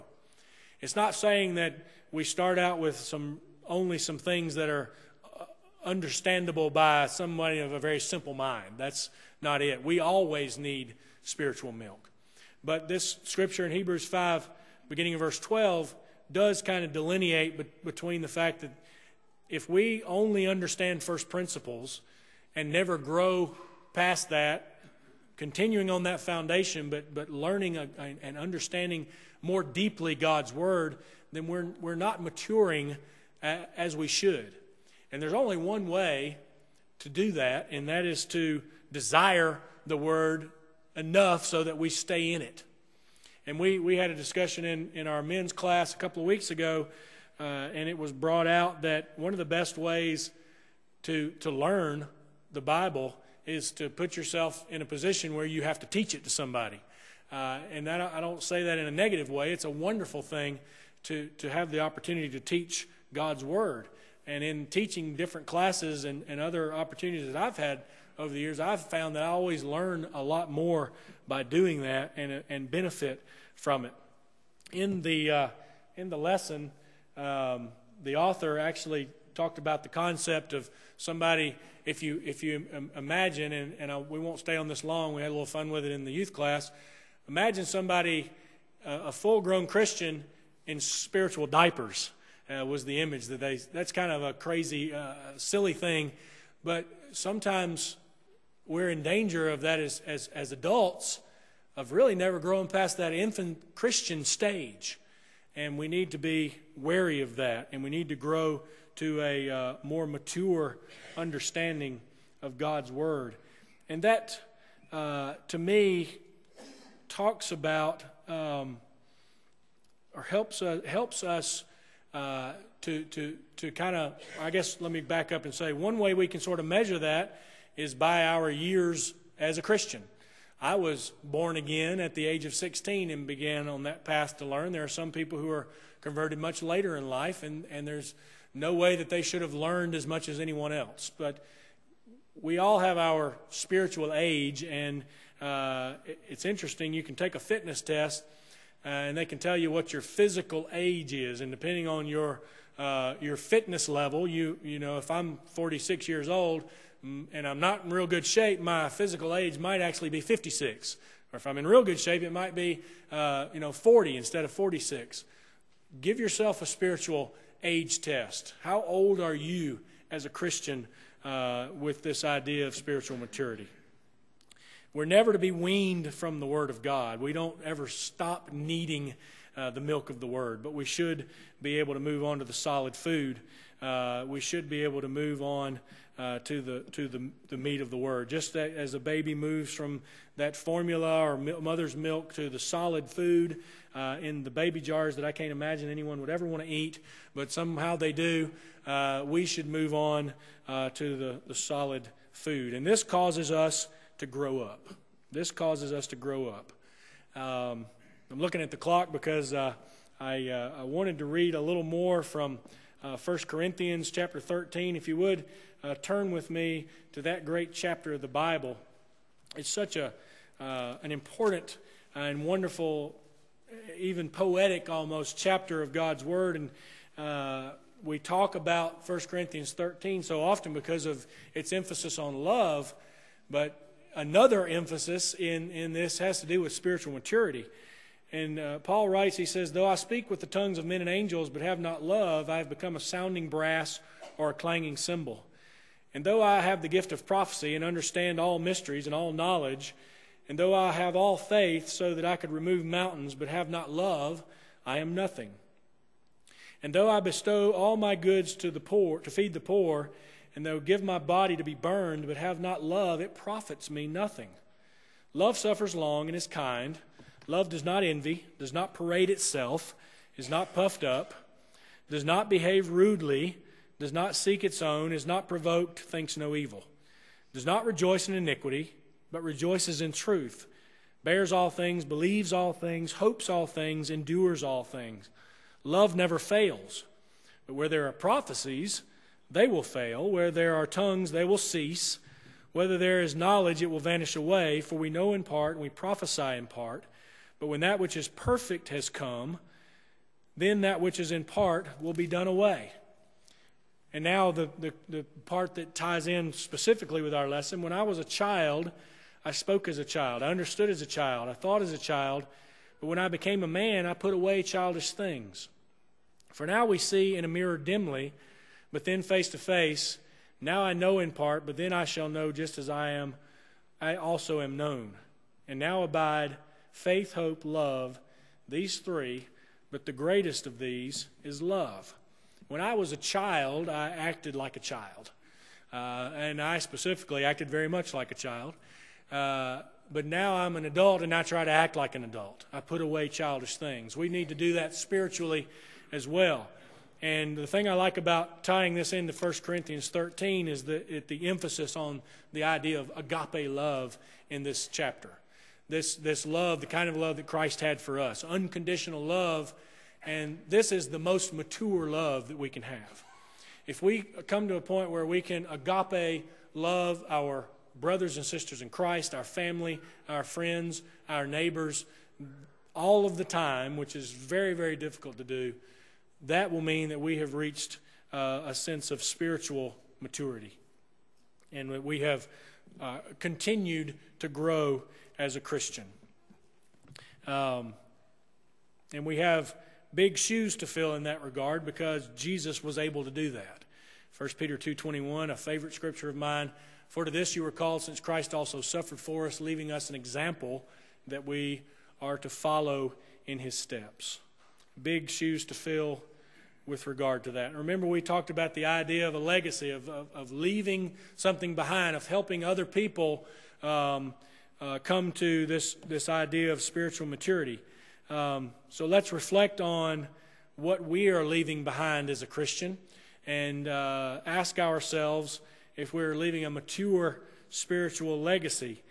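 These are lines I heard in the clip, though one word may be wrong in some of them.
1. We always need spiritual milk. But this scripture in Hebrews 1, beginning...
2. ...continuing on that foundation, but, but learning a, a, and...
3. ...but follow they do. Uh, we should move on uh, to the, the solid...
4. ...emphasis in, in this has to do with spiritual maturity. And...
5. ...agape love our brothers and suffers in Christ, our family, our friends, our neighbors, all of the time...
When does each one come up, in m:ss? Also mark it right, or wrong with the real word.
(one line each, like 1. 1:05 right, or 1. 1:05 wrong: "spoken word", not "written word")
1. 0:09 wrong: "5", not "1"
2. 0:25 right
3. 3:17 wrong: "somehow", not "follow"
4. 3:54 right
5. 6:05 wrong: "sisters", not "suffers".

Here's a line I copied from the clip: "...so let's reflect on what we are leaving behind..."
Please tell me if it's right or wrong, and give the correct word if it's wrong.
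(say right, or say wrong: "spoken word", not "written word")
right.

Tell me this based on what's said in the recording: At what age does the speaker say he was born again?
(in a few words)
16.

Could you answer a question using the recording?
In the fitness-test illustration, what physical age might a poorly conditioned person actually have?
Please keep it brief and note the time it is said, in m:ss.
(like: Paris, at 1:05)
56, at 2:40.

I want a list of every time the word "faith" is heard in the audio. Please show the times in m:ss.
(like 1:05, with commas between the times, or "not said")
4:11, 5:26.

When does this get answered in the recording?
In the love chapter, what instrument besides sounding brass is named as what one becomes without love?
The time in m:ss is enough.
4:04.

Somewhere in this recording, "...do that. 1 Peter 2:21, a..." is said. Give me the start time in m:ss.
6:33.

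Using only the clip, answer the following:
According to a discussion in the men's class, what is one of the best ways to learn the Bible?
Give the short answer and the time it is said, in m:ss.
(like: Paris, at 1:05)
Teach it to somebody, at 0:55.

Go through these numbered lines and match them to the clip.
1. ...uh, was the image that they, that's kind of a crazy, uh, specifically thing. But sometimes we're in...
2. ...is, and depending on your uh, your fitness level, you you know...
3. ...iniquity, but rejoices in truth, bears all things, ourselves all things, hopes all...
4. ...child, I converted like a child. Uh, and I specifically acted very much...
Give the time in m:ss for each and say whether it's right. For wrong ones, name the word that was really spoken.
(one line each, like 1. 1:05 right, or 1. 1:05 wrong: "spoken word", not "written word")
1. 1:32 wrong: "silly", not "specifically"
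2. 2:31 right
3. 4:38 wrong: "believes", not "ourselves"
4. 5:33 wrong: "acted", not "converted".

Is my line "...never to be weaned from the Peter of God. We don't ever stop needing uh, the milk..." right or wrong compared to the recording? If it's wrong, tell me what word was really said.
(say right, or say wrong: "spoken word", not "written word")
wrong: "Word", not "Peter".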